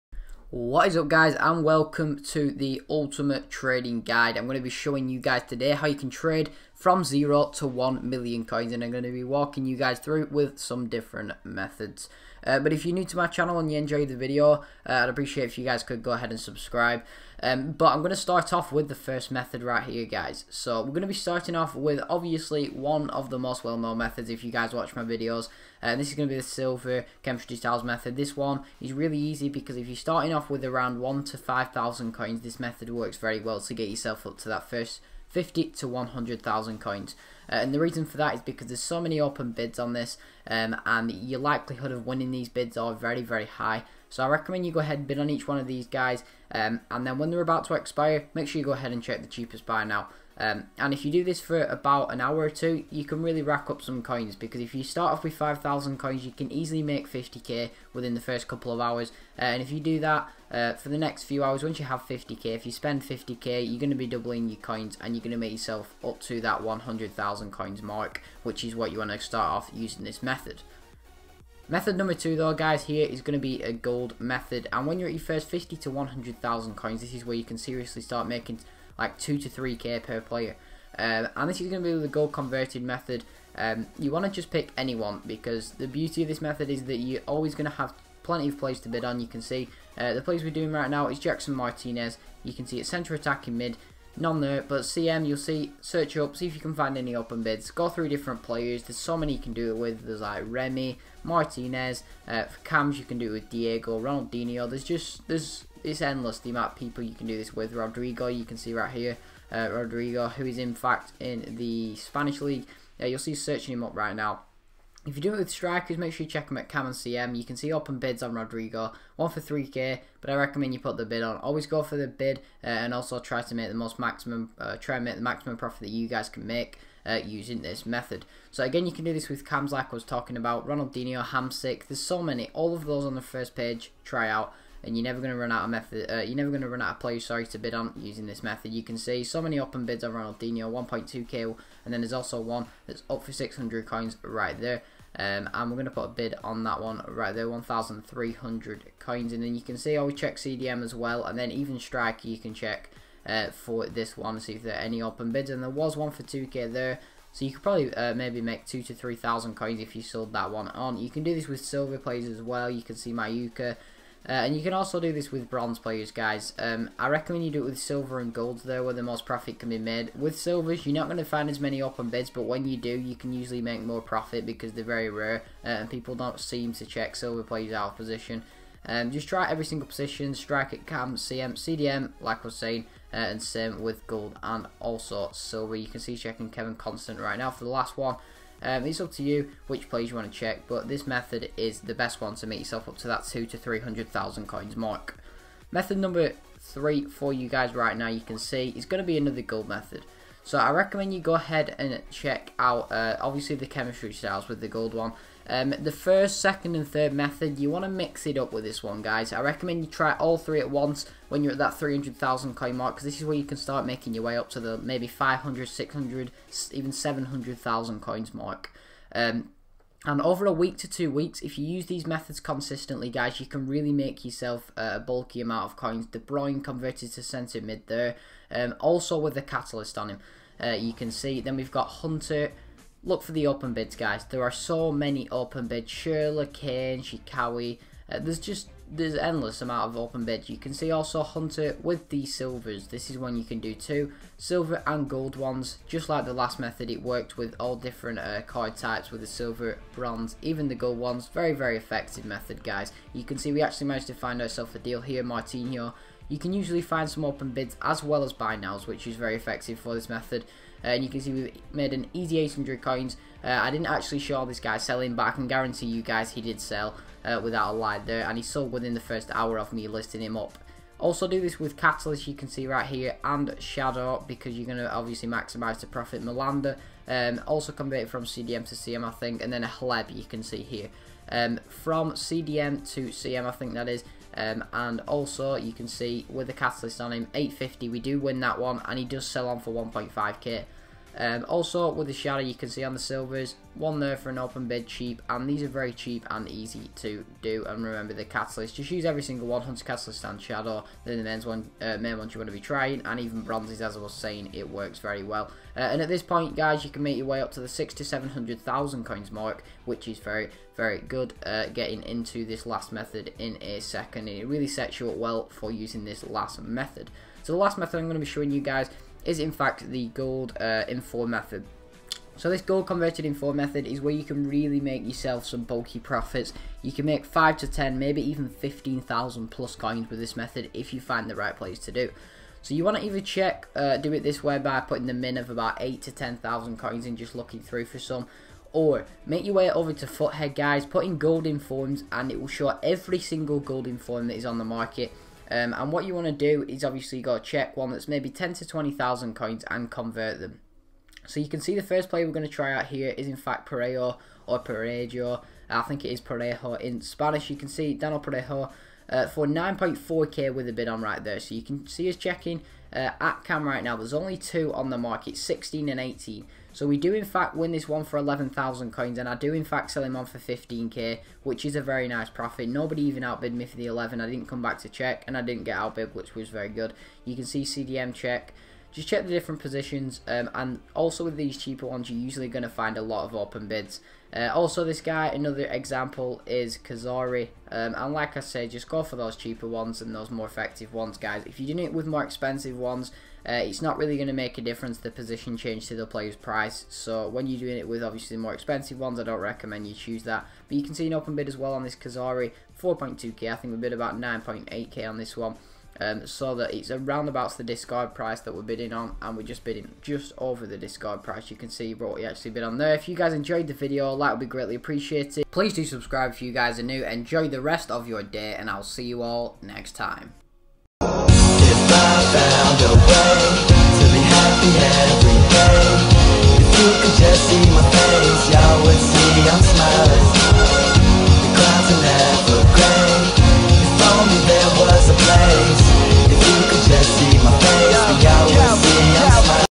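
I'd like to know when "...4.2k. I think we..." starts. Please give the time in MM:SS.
06:42.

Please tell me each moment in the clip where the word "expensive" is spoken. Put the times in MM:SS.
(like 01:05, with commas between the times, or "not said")
06:32, 06:38.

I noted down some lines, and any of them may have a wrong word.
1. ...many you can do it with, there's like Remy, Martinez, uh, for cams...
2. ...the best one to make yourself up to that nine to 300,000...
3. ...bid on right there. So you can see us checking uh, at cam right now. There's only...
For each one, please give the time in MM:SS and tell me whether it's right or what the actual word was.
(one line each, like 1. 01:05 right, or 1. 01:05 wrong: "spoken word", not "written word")
1. 01:39 right
2. 03:11 wrong: "two", not "nine"
3. 06:00 right.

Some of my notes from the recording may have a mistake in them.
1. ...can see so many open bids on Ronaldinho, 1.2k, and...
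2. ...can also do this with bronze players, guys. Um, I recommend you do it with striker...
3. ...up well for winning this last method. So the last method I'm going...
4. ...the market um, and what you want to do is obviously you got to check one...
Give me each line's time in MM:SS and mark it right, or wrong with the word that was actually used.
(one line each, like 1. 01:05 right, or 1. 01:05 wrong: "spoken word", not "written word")
1. 02:18 right
2. 02:44 wrong: "silver", not "striker"
3. 05:15 wrong: "using", not "winning"
4. 05:44 right.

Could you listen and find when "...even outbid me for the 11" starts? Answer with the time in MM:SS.
06:13.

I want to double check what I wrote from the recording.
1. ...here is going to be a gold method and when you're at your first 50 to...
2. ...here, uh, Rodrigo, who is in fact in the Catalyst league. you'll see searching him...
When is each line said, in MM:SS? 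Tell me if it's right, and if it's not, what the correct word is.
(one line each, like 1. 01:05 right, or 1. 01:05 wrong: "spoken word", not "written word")
1. 01:12 right
2. 01:48 wrong: "Spanish", not "Catalyst".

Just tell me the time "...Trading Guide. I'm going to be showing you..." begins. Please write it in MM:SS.
00:03.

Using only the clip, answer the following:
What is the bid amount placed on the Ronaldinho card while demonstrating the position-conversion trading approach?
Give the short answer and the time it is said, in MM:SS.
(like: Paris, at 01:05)
1300 coins, at 02:27.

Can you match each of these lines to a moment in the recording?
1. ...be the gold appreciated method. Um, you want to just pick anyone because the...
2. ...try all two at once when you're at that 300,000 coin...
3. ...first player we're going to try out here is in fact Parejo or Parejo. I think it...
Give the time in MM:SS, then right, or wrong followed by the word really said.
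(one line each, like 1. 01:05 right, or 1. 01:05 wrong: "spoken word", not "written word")
1. 01:21 wrong: "converted", not "appreciated"
2. 03:29 wrong: "three", not "two"
3. 05:51 right.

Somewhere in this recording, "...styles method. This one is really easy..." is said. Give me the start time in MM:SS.
00:27.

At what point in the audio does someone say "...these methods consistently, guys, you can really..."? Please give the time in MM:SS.
03:41.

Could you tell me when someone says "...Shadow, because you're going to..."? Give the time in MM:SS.
04:33.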